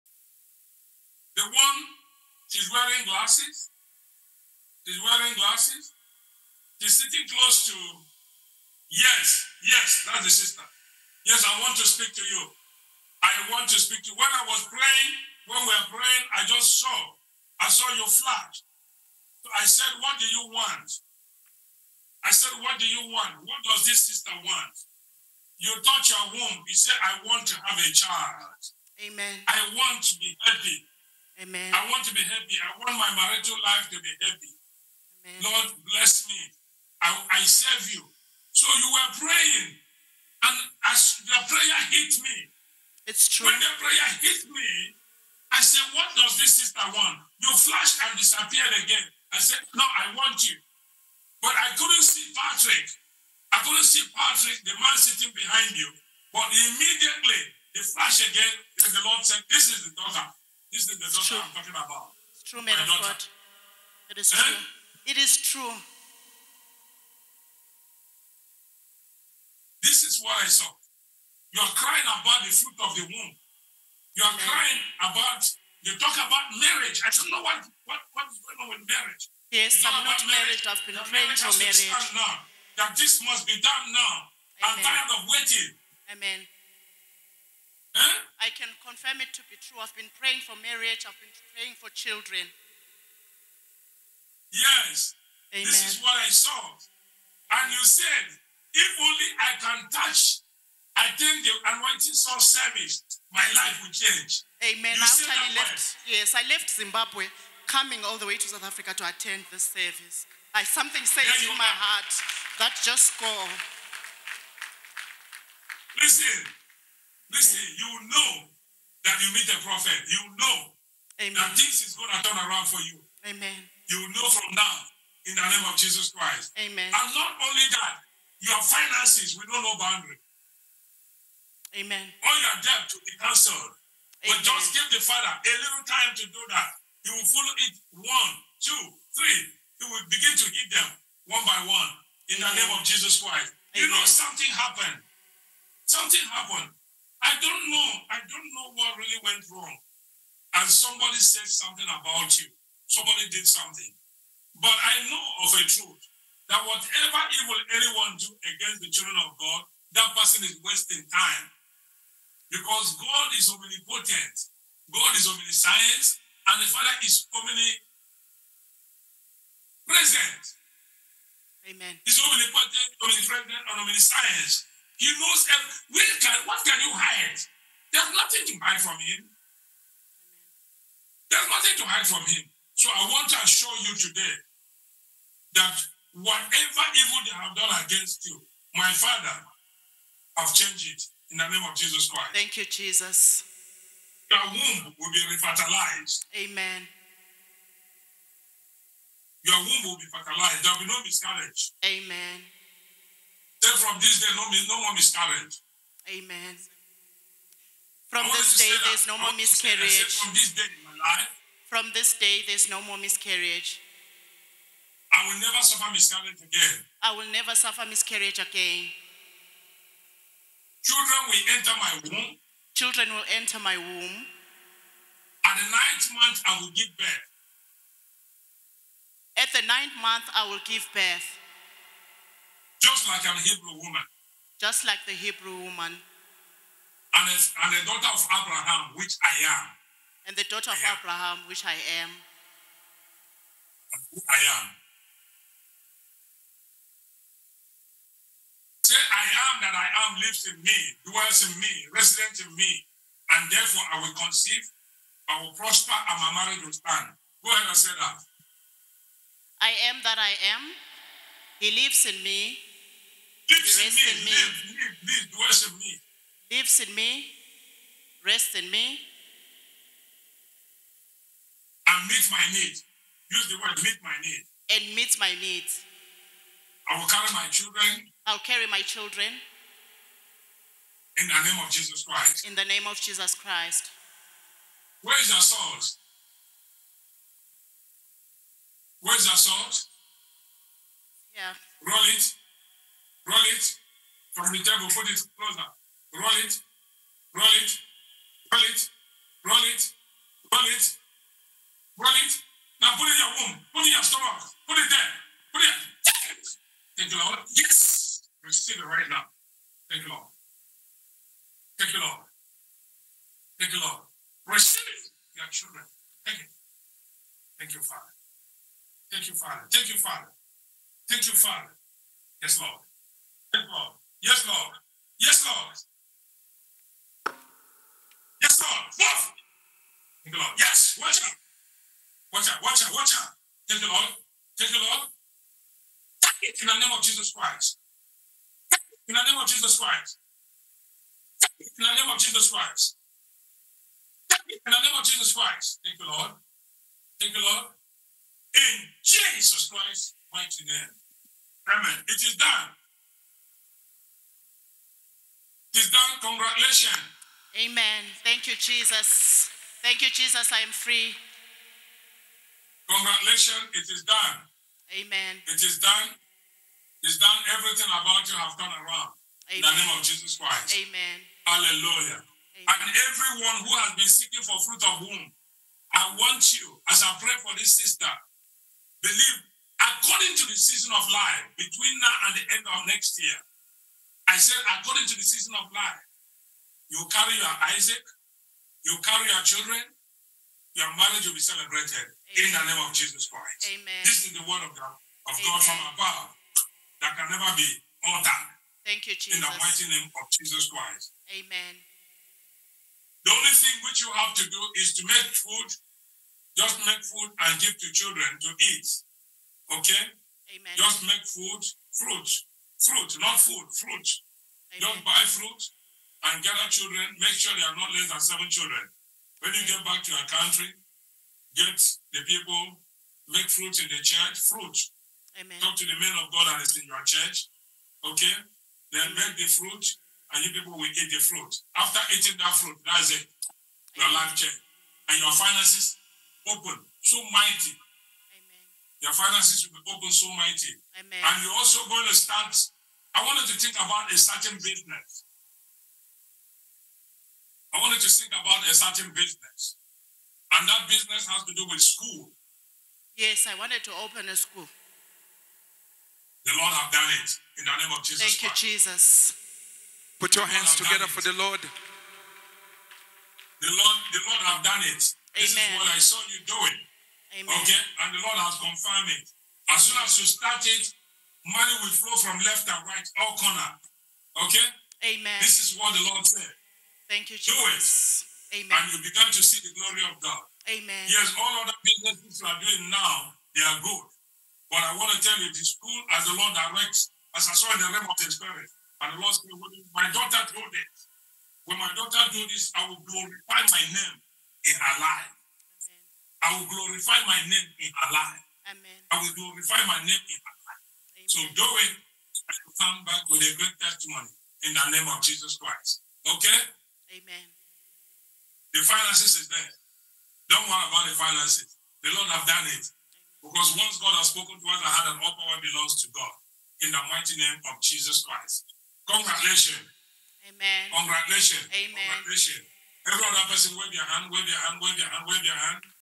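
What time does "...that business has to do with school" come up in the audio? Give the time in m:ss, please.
7:30.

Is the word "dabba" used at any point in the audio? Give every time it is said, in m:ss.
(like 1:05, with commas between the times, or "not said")
not said.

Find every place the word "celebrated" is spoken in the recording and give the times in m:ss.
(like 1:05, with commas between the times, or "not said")
6:31.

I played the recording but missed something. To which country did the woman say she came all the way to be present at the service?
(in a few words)
South Africa.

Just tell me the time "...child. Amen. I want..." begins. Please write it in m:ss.
0:27.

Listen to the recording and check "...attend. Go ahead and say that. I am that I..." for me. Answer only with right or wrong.
wrong.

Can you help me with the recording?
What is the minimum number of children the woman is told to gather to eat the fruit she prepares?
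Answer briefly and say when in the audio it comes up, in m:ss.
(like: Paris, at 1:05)
7, at 6:58.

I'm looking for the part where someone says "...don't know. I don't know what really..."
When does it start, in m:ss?
2:27.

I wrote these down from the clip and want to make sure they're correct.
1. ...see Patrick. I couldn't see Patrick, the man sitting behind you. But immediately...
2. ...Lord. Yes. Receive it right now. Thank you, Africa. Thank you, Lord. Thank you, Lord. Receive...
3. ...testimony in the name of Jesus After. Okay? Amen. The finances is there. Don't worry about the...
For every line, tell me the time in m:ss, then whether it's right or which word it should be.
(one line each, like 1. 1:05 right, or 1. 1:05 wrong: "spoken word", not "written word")
1. 0:52 right
2. 5:07 wrong: "Lord", not "Africa"
3. 8:23 wrong: "Christ", not "After".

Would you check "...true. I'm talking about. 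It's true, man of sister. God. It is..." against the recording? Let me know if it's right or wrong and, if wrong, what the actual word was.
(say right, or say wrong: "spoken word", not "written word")
wrong: "daughter", not "sister".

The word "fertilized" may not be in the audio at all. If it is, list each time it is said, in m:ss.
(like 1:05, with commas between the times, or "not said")
3:20.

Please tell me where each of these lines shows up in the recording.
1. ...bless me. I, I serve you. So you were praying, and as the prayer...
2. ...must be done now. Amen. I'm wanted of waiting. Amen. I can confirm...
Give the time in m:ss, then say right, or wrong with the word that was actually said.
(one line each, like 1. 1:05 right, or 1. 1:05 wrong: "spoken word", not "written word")
1. 0:35 right
2. 1:23 wrong: "tired", not "wanted".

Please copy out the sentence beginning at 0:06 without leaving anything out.
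She's sitting close to, yes, yes, that's the sister.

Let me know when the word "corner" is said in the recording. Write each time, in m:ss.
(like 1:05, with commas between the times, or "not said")
7:53.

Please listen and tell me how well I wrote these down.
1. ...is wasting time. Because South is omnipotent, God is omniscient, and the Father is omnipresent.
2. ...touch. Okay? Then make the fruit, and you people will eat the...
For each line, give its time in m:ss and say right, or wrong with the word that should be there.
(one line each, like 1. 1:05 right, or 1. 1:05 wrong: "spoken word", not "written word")
1. 2:40 wrong: "God", not "South"
2. 7:07 wrong: "church", not "touch".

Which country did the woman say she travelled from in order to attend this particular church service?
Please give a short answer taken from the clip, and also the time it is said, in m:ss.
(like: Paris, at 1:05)
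Zimbabwe, at 1:46.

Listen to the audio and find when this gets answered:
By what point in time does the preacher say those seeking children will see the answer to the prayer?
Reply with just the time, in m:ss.
6:22.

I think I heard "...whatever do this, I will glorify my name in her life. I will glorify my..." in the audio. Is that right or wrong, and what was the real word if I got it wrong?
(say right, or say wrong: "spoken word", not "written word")
wrong: "daughter", not "whatever".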